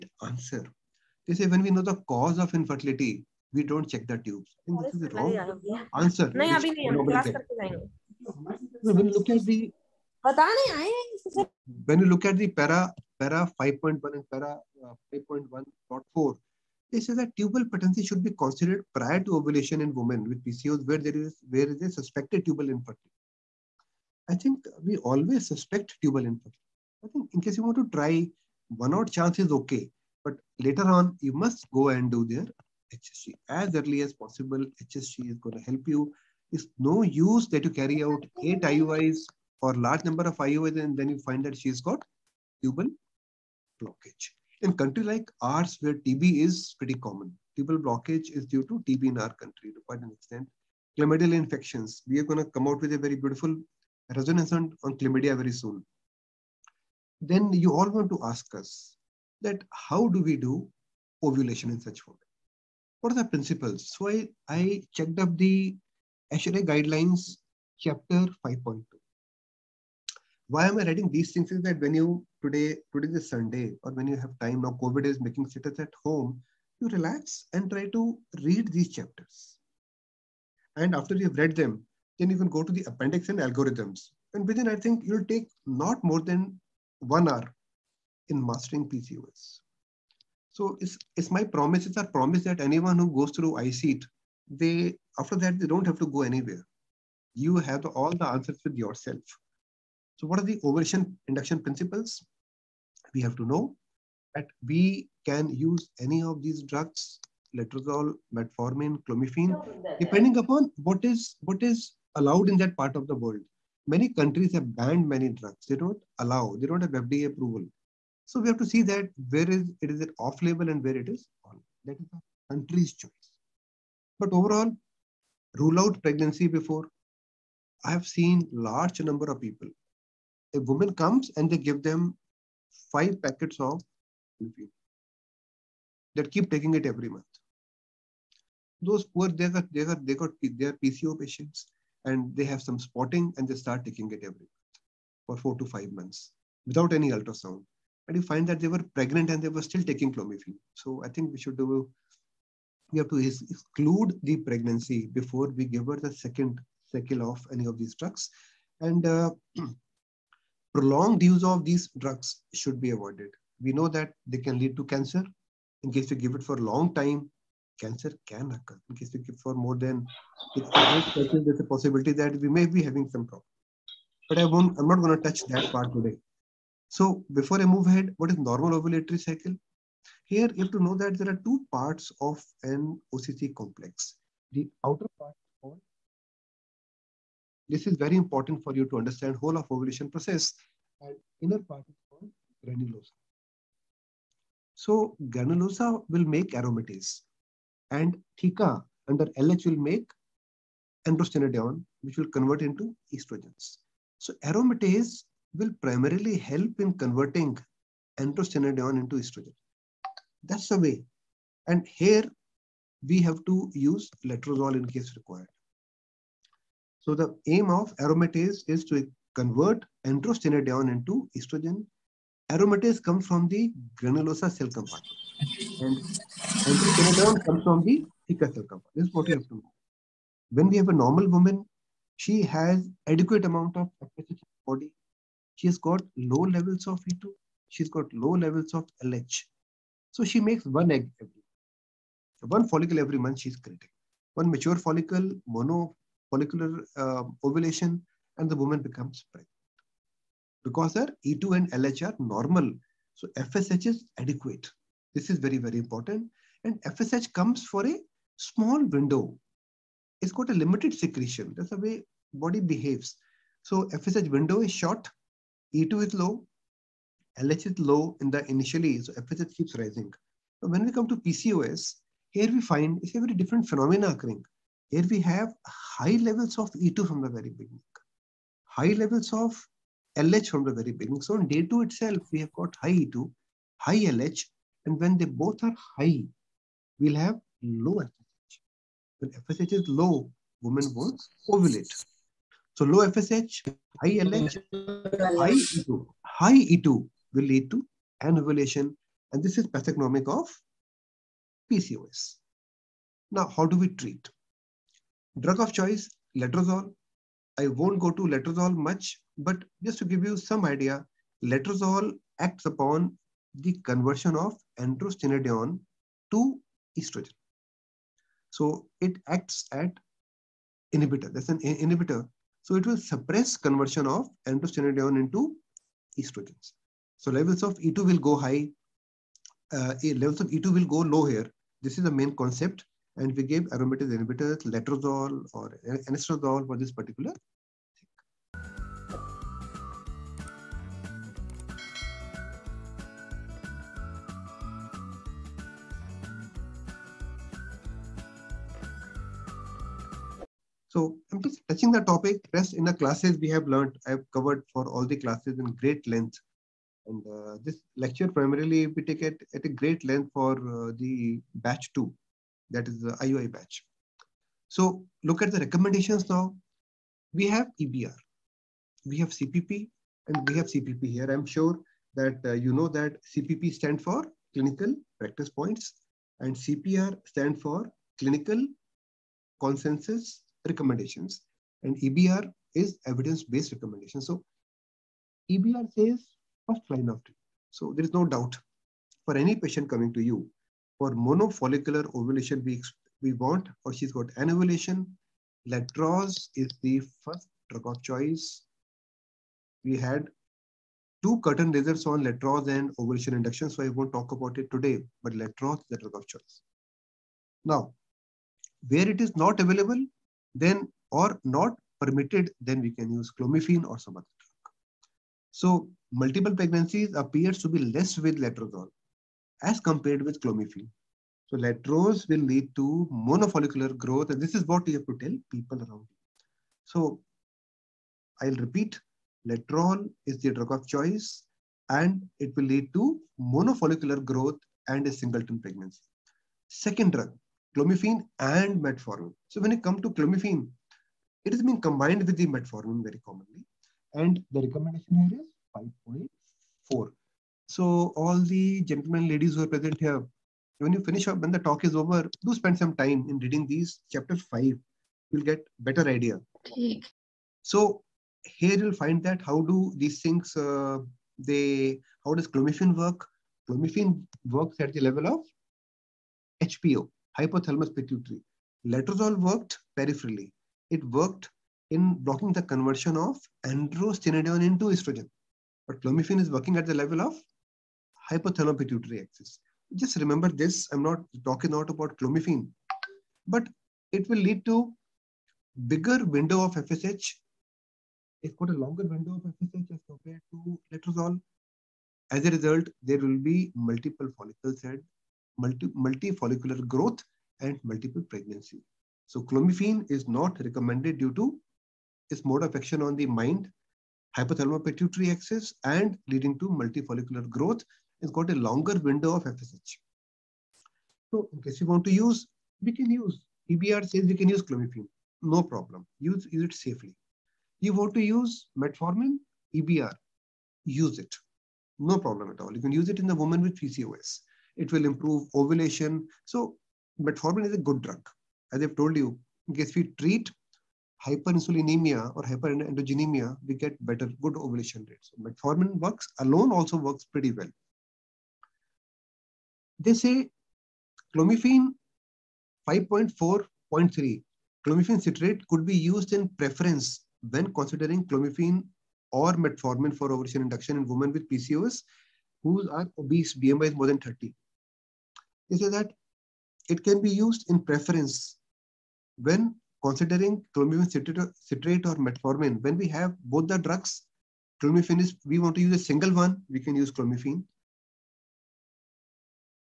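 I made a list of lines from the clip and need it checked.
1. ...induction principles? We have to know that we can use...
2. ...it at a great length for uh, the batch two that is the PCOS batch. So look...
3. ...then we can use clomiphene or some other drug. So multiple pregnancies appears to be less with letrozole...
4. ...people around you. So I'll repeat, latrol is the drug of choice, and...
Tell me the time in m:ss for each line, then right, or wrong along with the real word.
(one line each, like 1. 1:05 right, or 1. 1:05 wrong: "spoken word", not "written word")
1. 1:41 right
2. 5:59 wrong: "IOI", not "PCOS"
3. 6:52 right
4. 7:05 right.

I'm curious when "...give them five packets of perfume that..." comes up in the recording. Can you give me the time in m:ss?
2:11.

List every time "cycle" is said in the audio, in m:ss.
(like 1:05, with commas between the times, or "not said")
2:36, 2:59.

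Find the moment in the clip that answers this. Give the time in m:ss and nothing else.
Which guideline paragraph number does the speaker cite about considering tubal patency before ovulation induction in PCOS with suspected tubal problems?
0:15.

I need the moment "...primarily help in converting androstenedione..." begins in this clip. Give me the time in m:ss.
3:25.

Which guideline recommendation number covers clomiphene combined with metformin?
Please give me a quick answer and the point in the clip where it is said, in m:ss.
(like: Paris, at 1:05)
5.4, at 7:26.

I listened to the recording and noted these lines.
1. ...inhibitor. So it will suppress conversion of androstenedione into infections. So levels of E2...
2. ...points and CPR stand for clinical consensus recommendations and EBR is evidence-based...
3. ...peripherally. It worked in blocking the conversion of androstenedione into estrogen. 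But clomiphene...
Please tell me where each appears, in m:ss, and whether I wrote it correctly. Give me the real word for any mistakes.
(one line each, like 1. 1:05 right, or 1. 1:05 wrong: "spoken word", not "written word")
1. 5:21 wrong: "estrogens", not "infections"
2. 6:15 right
3. 7:49 right.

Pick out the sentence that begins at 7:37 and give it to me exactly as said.
So here you'll find that how do these things, uh, they, how does clomiphene work?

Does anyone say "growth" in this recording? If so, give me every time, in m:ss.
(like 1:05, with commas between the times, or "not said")
7:03, 7:14, 8:16, 8:27.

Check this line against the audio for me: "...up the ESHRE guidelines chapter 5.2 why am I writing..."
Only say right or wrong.
right.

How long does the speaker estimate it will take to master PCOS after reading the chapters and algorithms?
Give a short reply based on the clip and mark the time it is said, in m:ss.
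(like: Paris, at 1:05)
one hour, at 1:26.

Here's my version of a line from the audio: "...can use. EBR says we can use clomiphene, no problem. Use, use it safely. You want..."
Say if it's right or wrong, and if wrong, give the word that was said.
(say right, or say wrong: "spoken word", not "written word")
right.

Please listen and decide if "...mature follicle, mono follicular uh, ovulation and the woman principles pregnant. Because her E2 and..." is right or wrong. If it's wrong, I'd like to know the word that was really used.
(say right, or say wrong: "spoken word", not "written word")
wrong: "becomes", not "principles".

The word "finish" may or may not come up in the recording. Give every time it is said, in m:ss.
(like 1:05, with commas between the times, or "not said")
7:31.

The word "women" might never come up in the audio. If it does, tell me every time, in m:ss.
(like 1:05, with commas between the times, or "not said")
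0:19, 1:02, 4:50, 9:11.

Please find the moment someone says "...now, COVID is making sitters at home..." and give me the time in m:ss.
1:14.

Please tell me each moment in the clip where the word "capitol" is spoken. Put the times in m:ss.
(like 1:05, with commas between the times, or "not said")
not said.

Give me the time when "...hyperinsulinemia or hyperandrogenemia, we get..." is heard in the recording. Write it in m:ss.
8:51.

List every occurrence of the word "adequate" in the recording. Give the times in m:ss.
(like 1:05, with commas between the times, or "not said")
3:53, 4:14.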